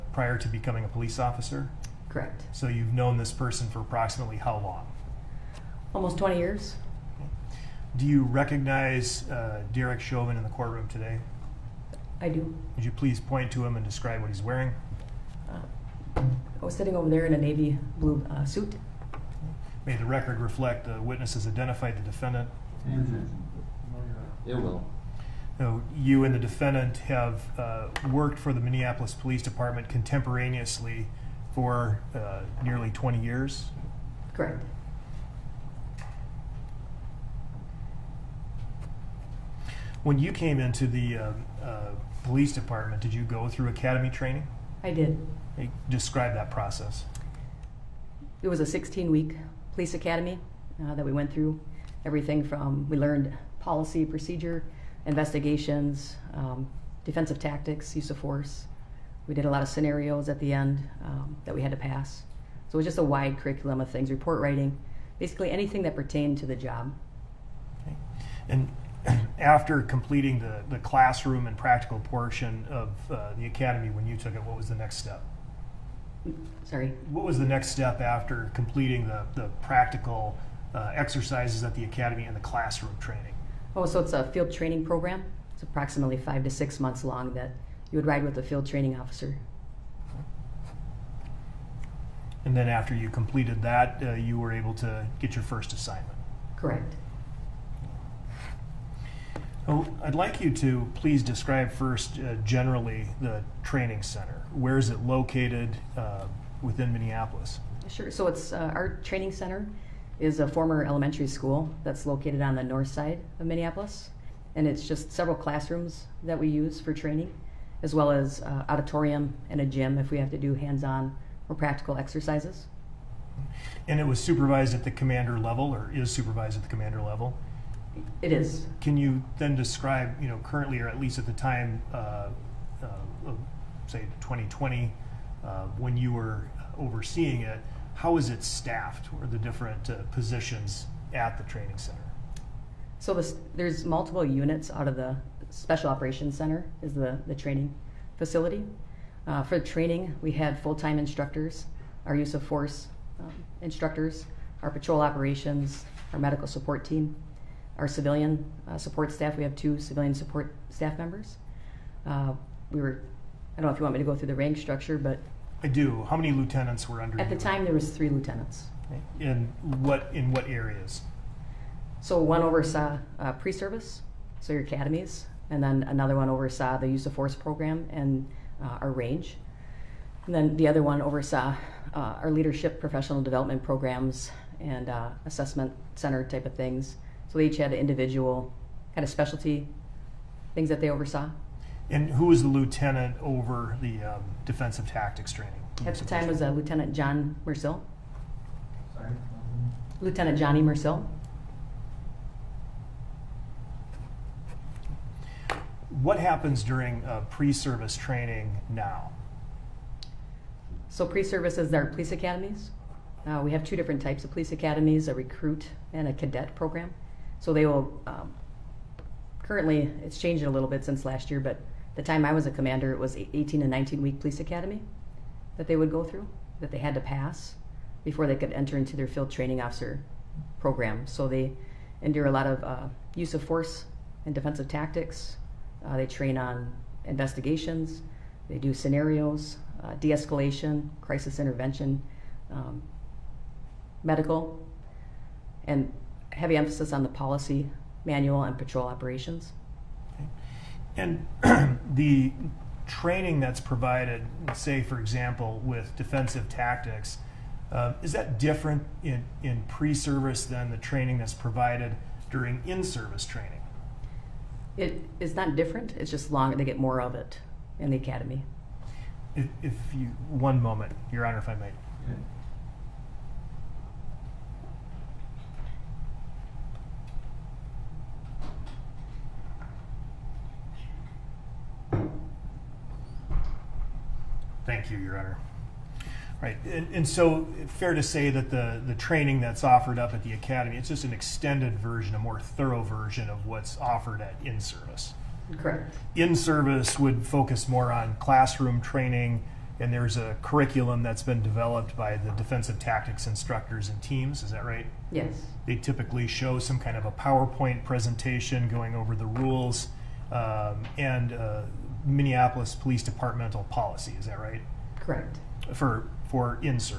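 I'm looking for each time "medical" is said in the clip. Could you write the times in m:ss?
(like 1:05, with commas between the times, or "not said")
2:36, 4:04.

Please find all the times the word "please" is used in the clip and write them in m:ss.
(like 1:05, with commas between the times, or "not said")
0:12, 1:40.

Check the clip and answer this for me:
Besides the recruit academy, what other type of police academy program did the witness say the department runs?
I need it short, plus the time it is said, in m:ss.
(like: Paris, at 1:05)
cadet program, at 3:36.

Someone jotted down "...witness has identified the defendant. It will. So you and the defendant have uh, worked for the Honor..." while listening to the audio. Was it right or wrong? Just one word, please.
wrong.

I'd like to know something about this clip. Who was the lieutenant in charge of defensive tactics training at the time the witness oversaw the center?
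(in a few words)
Johnny Mercil.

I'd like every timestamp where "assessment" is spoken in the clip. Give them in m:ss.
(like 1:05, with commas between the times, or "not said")
3:05.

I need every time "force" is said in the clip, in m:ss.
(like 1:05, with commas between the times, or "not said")
0:58, 2:32, 2:57, 3:53.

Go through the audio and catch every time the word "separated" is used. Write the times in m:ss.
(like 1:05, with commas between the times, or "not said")
not said.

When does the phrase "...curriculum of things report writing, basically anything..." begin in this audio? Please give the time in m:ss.
1:03.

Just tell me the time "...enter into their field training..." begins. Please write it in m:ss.
3:48.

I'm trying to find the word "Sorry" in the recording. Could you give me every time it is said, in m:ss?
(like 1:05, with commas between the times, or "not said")
1:16, 3:18.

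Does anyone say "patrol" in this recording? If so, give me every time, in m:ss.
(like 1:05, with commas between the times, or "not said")
2:34, 4:08.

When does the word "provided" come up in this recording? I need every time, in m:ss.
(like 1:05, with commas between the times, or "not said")
4:13, 4:21.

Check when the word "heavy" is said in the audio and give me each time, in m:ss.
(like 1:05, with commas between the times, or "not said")
4:06.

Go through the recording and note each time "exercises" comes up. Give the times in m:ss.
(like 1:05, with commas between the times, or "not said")
1:20, 2:01.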